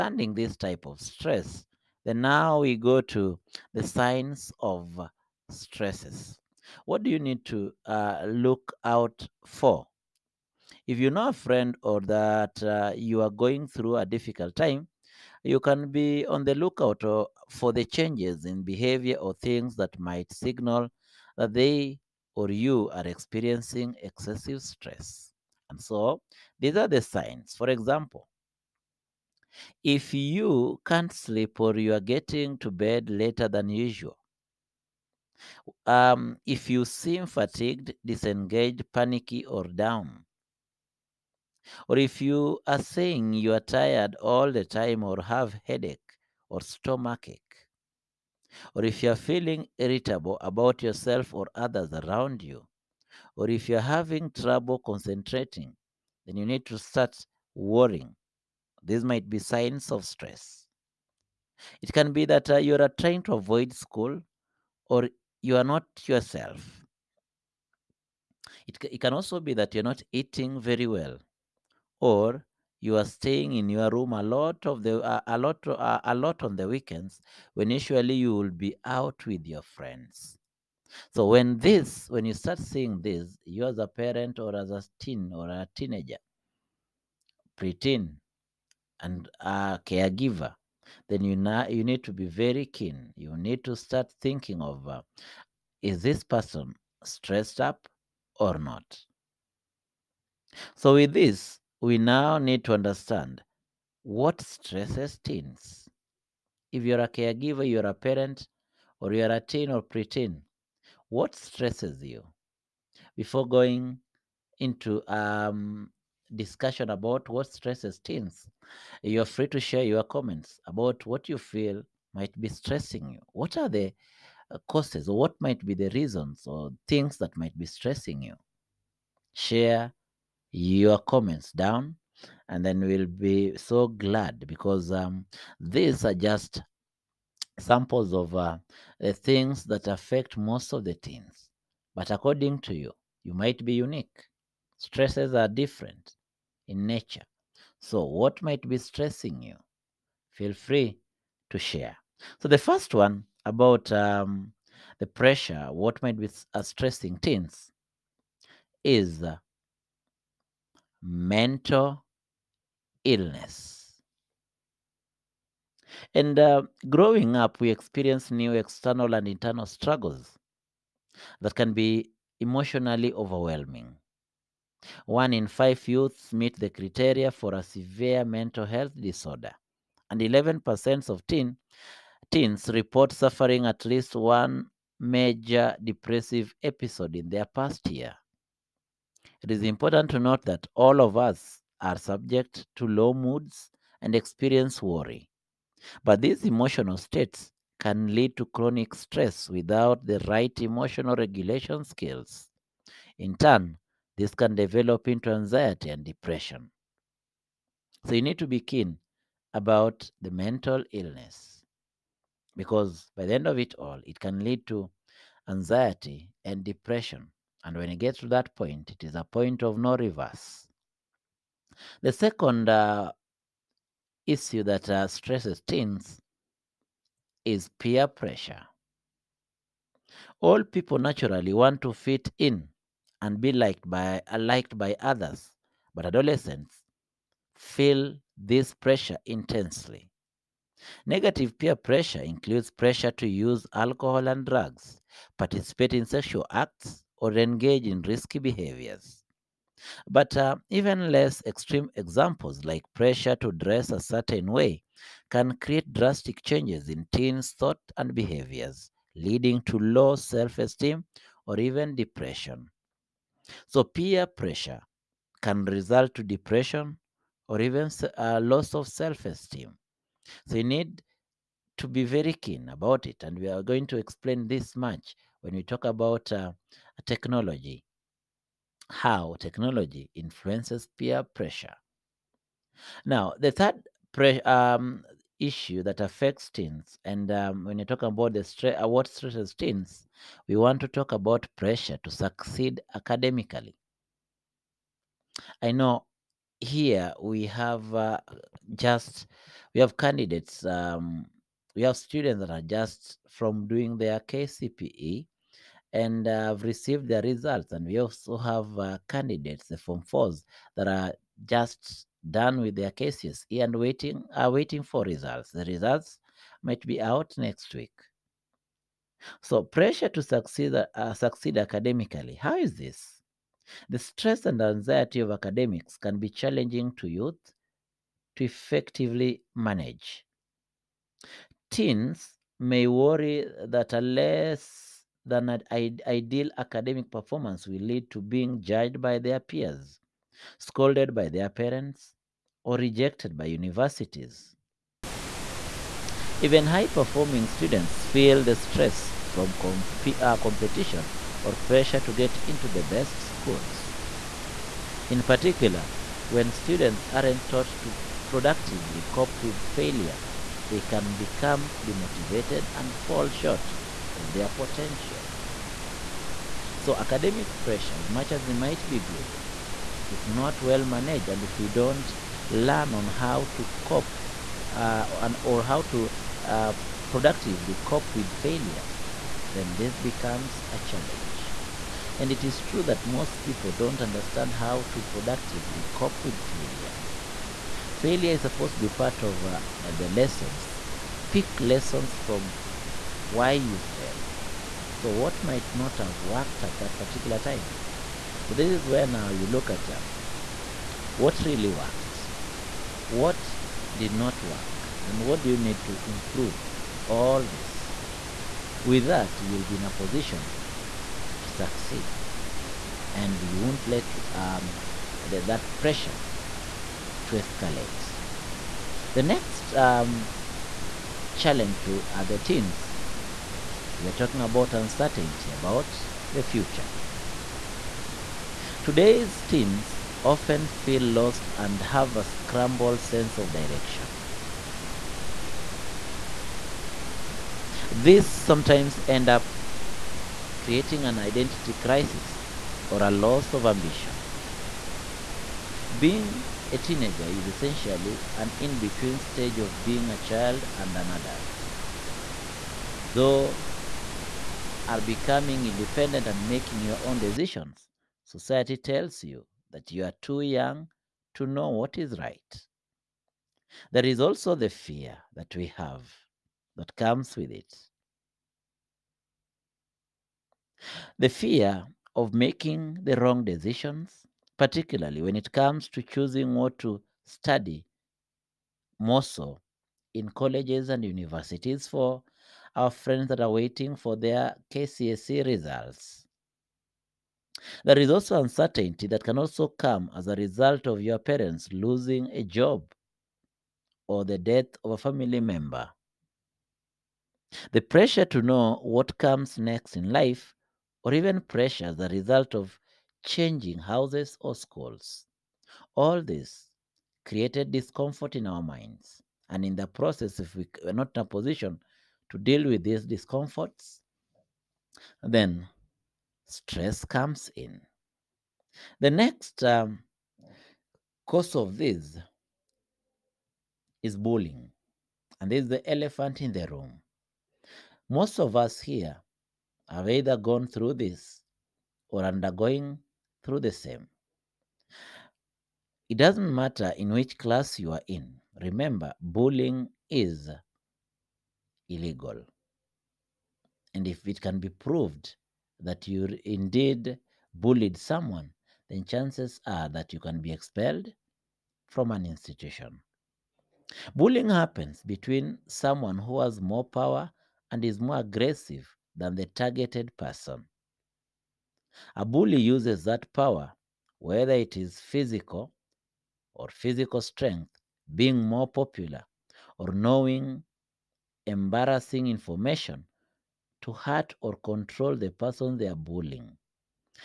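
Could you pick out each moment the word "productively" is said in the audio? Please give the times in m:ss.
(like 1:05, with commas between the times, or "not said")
5:58, 6:17, 6:25.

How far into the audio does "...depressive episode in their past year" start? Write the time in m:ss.
3:05.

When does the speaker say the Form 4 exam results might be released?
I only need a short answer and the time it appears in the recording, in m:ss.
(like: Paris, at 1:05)
next week, at 5:17.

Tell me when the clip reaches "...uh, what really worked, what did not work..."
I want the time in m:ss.
6:39.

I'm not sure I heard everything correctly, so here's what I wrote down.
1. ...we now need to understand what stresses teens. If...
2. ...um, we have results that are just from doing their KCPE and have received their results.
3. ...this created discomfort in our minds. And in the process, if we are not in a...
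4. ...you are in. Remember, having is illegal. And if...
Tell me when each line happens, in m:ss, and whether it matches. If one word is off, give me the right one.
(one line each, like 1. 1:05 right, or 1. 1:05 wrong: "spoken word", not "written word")
1. 1:41 right
2. 5:00 wrong: "students", not "results"
3. 8:26 right
4. 8:57 wrong: "bullying", not "having".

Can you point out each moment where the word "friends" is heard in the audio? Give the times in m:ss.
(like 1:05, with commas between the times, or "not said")
0:11, 1:19, 8:02.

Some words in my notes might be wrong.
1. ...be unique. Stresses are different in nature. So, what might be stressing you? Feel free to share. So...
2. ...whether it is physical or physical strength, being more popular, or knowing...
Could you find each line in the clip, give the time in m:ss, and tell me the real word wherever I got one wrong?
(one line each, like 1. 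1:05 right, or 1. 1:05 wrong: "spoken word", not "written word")
1. 2:23 right
2. 9:24 right.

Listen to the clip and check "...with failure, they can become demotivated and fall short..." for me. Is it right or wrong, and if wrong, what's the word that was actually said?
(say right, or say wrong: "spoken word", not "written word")
right.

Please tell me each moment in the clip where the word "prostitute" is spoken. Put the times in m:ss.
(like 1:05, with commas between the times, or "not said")
not said.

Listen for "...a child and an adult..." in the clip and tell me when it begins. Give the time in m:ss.
7:30.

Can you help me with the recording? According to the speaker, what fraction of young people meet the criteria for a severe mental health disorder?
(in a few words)
1 in 5.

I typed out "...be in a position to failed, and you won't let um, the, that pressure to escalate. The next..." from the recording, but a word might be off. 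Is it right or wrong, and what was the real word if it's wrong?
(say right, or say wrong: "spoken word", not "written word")
wrong: "succeed", not "failed".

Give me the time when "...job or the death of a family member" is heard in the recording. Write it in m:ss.
8:12.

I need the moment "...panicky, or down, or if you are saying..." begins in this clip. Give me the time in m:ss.
0:38.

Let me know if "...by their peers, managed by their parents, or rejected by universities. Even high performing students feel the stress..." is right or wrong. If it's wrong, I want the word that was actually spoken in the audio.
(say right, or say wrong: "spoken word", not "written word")
wrong: "scolded", not "managed".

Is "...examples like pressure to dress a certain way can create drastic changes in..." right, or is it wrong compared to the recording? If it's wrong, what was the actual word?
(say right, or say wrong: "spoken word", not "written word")
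right.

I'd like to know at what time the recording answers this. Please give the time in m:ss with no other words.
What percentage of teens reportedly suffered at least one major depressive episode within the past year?
3:00.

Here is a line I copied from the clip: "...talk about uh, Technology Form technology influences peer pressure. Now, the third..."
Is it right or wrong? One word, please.
wrong.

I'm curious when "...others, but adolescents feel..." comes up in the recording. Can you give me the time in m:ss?
3:55.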